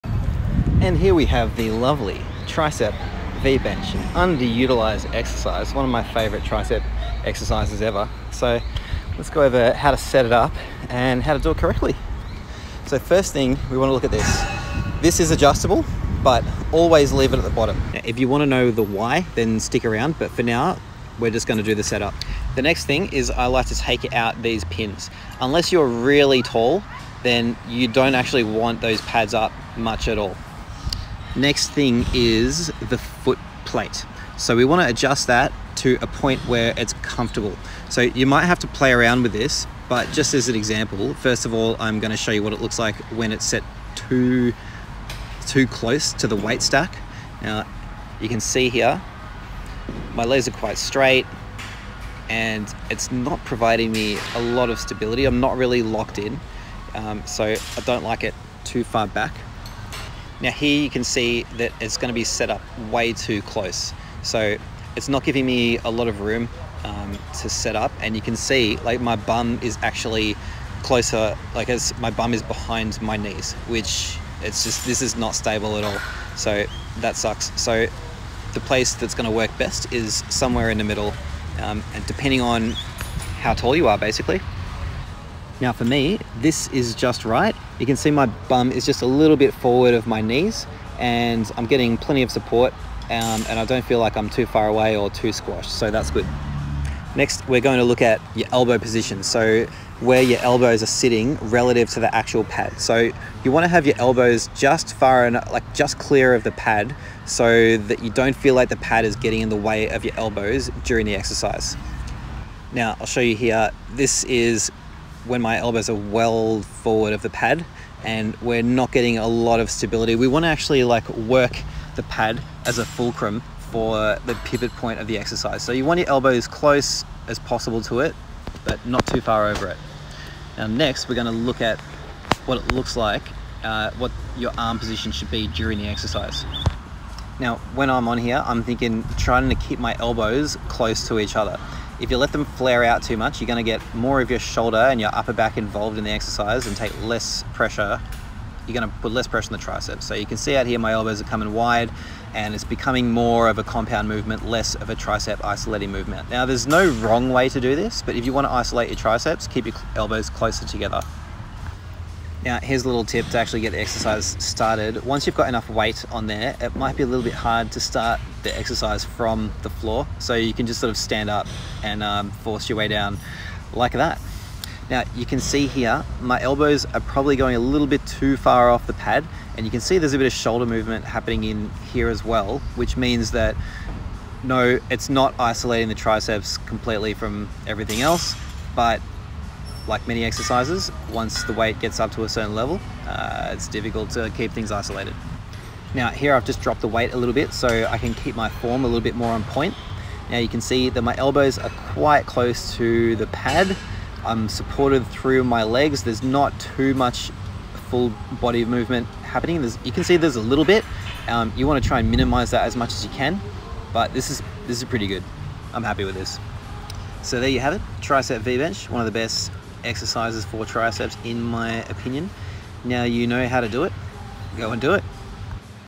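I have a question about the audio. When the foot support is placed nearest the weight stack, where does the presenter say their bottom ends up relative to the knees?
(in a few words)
Behind my knees.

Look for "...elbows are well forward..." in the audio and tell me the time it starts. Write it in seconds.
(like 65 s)
115 s.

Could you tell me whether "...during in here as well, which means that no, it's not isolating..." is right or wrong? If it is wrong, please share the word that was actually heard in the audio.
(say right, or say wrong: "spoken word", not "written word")
wrong: "happening", not "during".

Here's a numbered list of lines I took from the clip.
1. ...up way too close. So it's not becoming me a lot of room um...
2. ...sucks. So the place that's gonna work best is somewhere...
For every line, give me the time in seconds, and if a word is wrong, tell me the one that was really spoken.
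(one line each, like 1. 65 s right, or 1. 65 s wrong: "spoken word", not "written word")
1. 62 s wrong: "giving", not "becoming"
2. 77 s right.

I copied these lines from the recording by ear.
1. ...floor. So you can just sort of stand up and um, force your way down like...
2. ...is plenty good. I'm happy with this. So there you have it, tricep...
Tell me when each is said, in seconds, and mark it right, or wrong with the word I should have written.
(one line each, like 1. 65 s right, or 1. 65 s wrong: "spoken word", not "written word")
1. 169 s right
2. 214 s wrong: "pretty", not "plenty".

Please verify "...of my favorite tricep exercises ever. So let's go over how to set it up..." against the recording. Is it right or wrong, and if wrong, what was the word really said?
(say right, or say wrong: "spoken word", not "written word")
right.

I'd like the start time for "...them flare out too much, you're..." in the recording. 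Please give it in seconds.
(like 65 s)
142 s.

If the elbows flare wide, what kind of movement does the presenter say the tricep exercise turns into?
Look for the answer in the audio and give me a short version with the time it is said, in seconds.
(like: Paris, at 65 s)
Compound movement, at 153 s.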